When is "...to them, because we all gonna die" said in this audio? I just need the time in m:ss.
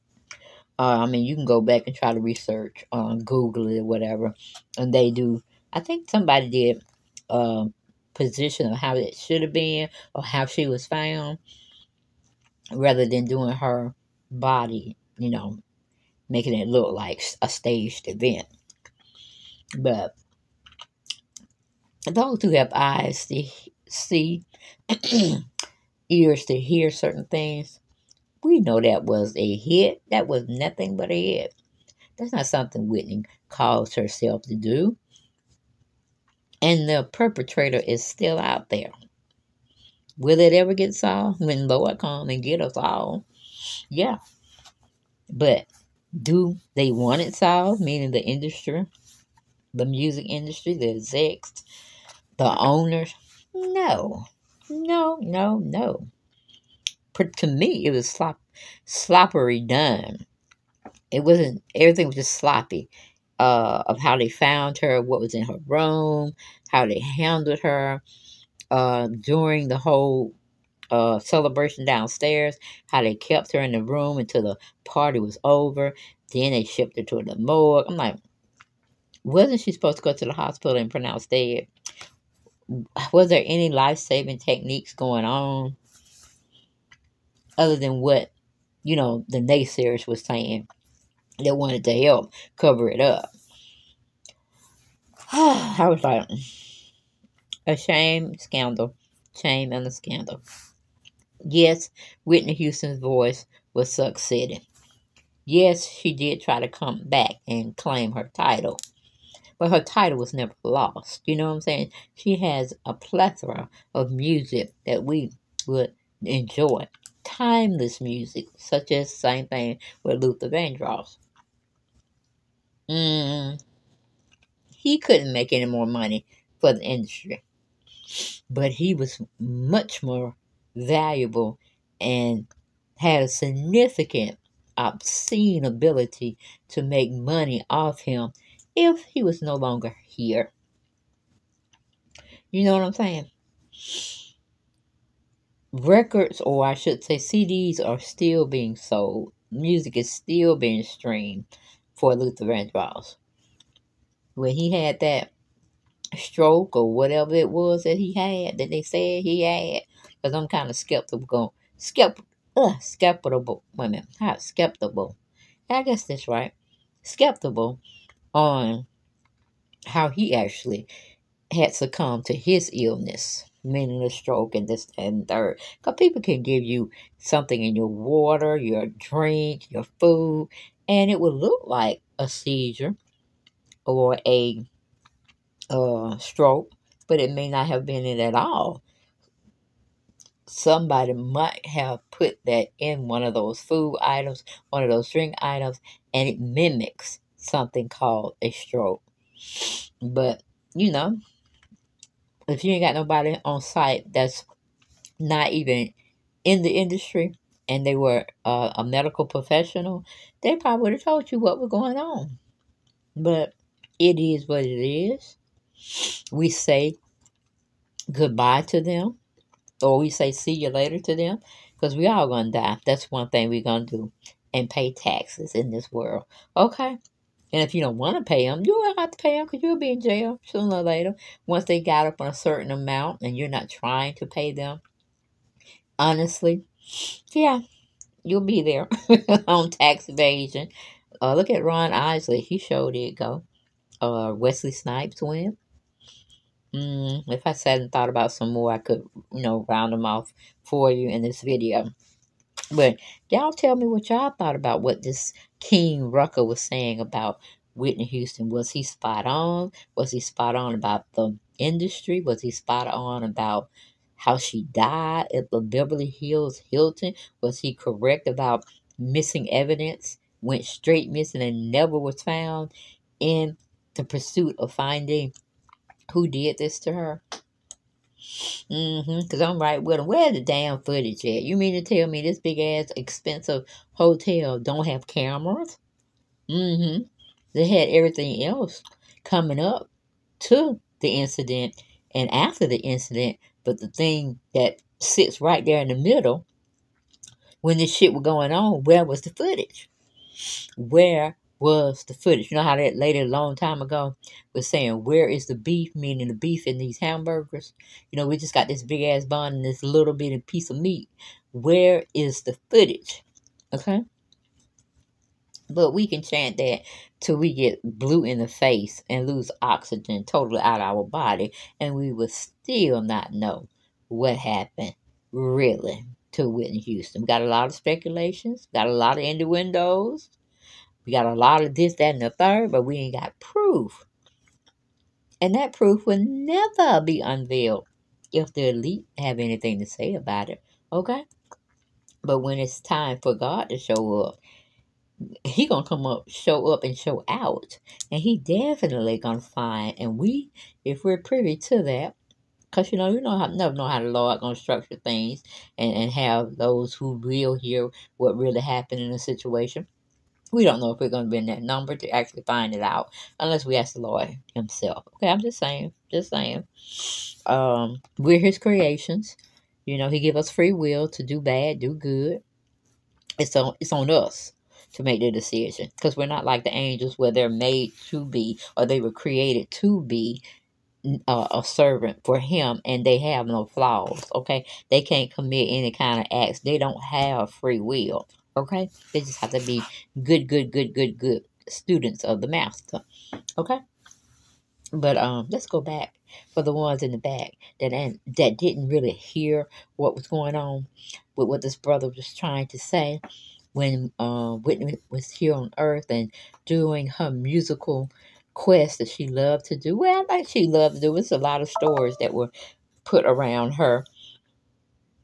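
3:40.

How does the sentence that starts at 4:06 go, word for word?
Mm, if I sat and thought about some more, I could, you know, round them off for you in this video.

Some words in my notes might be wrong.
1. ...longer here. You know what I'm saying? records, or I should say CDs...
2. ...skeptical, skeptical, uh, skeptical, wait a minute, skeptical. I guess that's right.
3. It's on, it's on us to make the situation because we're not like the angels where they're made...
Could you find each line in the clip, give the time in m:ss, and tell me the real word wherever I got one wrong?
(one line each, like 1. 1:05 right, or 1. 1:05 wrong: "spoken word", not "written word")
1. 2:19 right
2. 2:40 right
3. 6:13 wrong: "decision", not "situation".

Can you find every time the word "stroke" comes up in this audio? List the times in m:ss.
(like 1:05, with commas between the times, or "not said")
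2:36, 2:54, 3:06, 3:18.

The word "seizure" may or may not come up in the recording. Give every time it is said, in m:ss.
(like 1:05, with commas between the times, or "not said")
3:02.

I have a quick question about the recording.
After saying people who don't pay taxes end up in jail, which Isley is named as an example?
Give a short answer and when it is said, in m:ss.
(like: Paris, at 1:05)
Ron Isley, at 4:01.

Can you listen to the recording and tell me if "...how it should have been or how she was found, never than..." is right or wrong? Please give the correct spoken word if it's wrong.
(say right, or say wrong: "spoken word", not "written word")
wrong: "rather", not "never".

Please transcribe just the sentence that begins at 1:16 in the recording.
Then they shipped her to the morgue.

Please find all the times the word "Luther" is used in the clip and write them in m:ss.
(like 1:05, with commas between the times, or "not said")
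2:00, 2:32.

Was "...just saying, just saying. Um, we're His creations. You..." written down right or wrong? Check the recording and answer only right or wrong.
right.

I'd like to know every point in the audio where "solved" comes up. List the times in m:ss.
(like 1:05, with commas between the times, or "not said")
0:40, 0:47.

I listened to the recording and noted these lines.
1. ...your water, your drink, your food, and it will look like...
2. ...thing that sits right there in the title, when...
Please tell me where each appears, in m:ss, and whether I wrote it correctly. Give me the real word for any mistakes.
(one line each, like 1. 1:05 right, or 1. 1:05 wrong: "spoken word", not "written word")
1. 2:57 right
2. 4:53 wrong: "middle", not "title".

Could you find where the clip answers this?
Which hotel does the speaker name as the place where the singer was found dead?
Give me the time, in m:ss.
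4:25.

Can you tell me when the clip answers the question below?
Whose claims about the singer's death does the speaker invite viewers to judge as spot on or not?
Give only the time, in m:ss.
4:15.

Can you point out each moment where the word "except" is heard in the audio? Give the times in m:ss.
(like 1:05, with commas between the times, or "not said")
not said.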